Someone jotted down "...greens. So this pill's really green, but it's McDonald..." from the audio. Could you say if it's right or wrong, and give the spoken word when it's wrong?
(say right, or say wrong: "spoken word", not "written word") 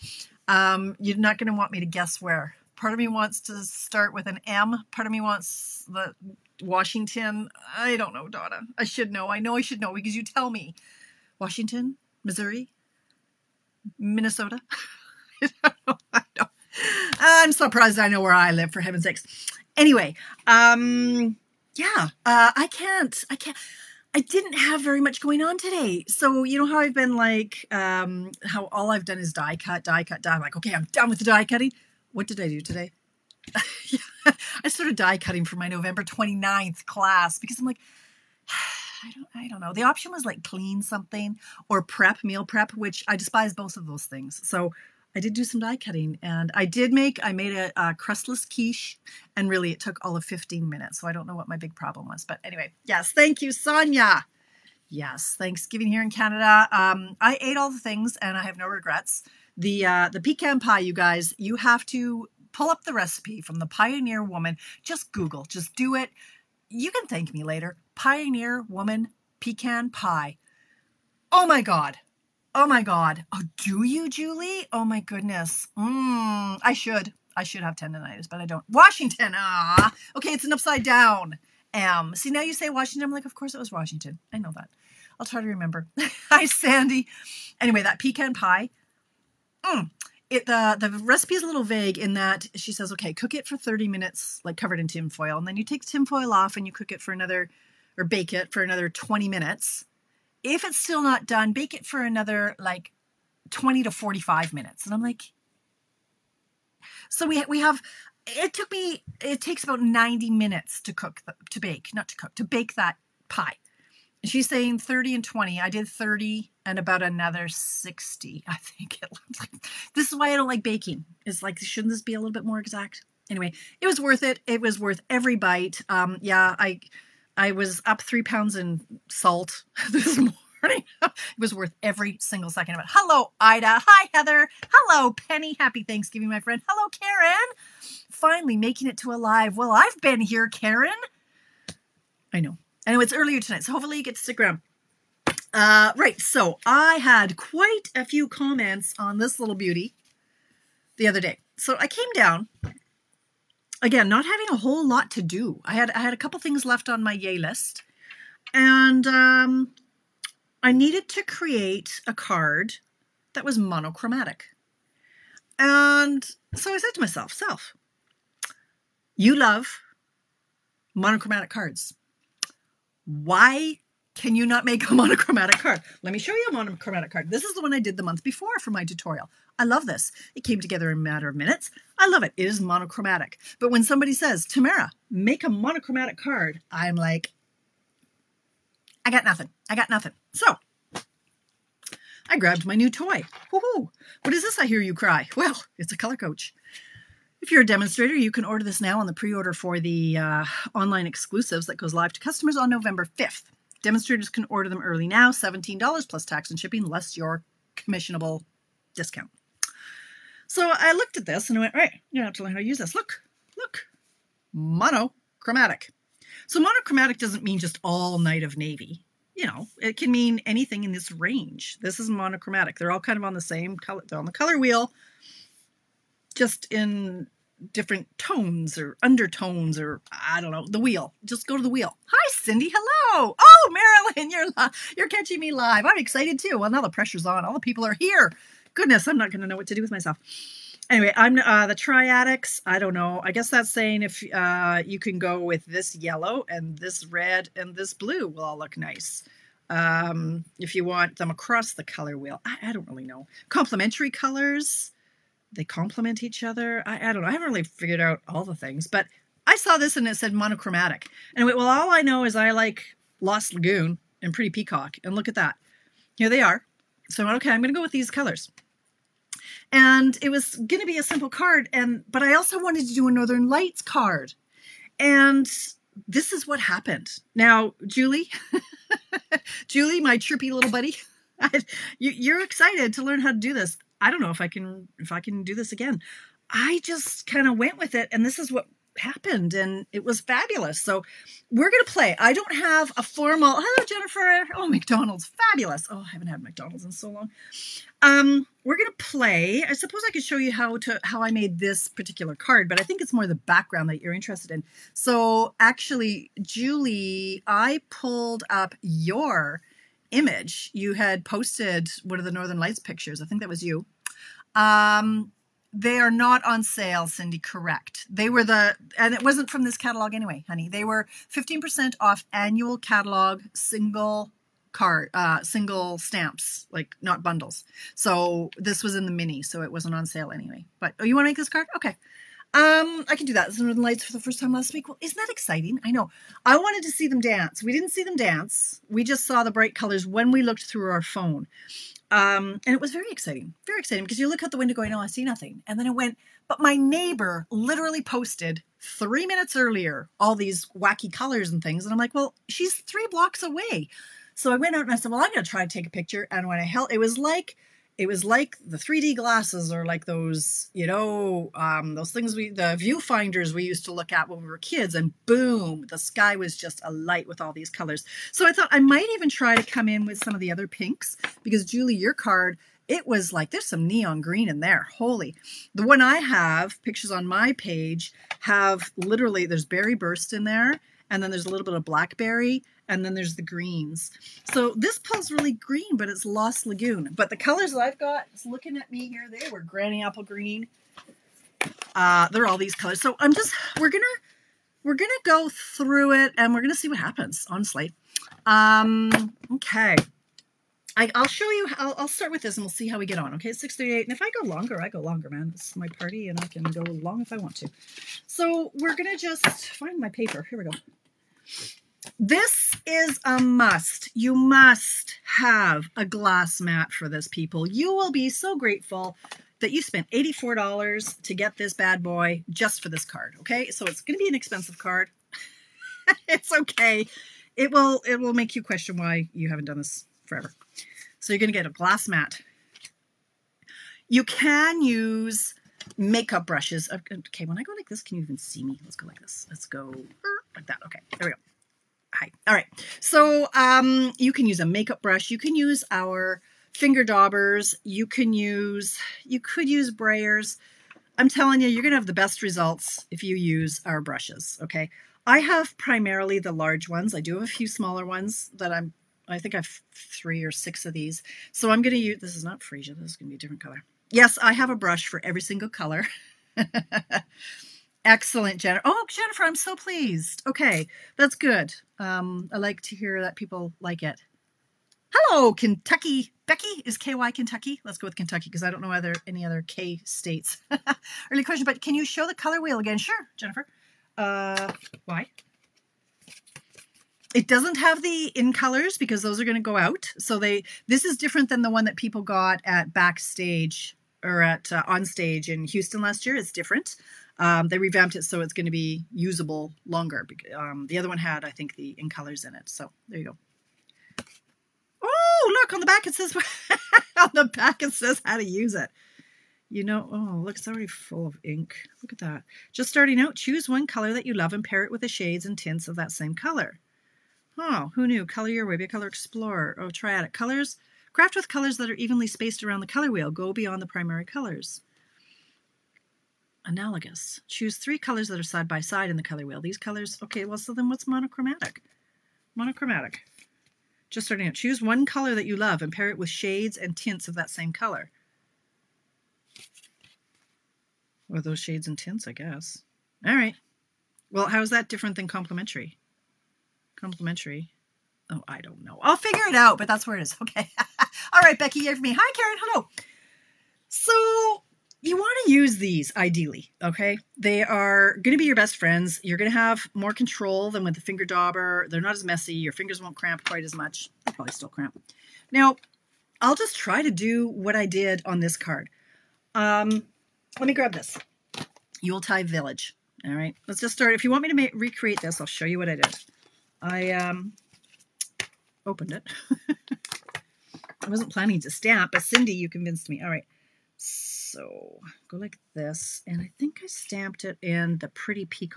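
wrong: "Lost", not "McDonald".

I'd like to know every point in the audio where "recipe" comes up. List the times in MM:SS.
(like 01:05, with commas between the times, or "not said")
01:02, 01:30.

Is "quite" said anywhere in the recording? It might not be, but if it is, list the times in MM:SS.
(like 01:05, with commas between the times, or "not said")
02:27, 09:23.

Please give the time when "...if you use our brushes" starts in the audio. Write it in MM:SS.
07:33.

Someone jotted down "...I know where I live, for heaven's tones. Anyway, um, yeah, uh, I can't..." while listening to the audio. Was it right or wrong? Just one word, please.
wrong.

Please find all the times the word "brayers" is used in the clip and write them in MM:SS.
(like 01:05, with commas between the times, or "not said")
07:29.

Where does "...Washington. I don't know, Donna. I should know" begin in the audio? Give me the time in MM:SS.
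00:06.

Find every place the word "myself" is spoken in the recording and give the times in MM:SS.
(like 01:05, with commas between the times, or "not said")
02:47, 03:59.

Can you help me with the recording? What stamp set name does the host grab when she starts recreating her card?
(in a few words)
Yuletide Village.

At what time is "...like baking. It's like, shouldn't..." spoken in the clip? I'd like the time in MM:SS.
02:00.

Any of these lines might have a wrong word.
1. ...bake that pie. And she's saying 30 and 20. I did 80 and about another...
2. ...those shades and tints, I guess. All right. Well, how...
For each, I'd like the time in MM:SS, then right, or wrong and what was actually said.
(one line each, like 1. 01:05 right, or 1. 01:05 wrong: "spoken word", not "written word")
1. 01:52 wrong: "30", not "80"
2. 09:01 right.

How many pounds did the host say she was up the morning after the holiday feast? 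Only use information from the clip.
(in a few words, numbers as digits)
3.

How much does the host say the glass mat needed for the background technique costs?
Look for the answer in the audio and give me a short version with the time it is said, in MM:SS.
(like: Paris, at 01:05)
$84, at 07:00.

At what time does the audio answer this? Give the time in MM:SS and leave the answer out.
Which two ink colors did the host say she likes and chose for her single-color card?
04:23.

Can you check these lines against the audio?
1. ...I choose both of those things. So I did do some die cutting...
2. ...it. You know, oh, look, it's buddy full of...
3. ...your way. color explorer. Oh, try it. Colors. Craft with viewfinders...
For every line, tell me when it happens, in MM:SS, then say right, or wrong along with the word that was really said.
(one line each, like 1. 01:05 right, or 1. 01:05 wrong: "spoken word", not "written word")
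1. 00:43 wrong: "despise", not "choose"
2. 08:28 wrong: "already", not "buddy"
3. 08:38 wrong: "colors", not "viewfinders".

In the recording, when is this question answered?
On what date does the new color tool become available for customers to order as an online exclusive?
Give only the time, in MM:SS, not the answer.
03:22.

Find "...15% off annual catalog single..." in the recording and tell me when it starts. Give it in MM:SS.
05:21.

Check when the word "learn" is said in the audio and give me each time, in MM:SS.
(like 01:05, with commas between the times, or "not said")
03:32, 04:43.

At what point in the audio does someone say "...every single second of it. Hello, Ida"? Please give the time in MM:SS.
02:11.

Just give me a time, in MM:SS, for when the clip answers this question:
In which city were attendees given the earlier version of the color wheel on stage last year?
08:15.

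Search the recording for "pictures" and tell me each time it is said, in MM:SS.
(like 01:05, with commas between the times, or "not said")
05:12, 05:55, 06:16.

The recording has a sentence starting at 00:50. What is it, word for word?
So I don't know what my big problem was.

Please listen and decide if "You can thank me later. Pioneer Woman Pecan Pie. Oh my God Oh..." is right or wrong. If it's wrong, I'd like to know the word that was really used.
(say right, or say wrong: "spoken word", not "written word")
right.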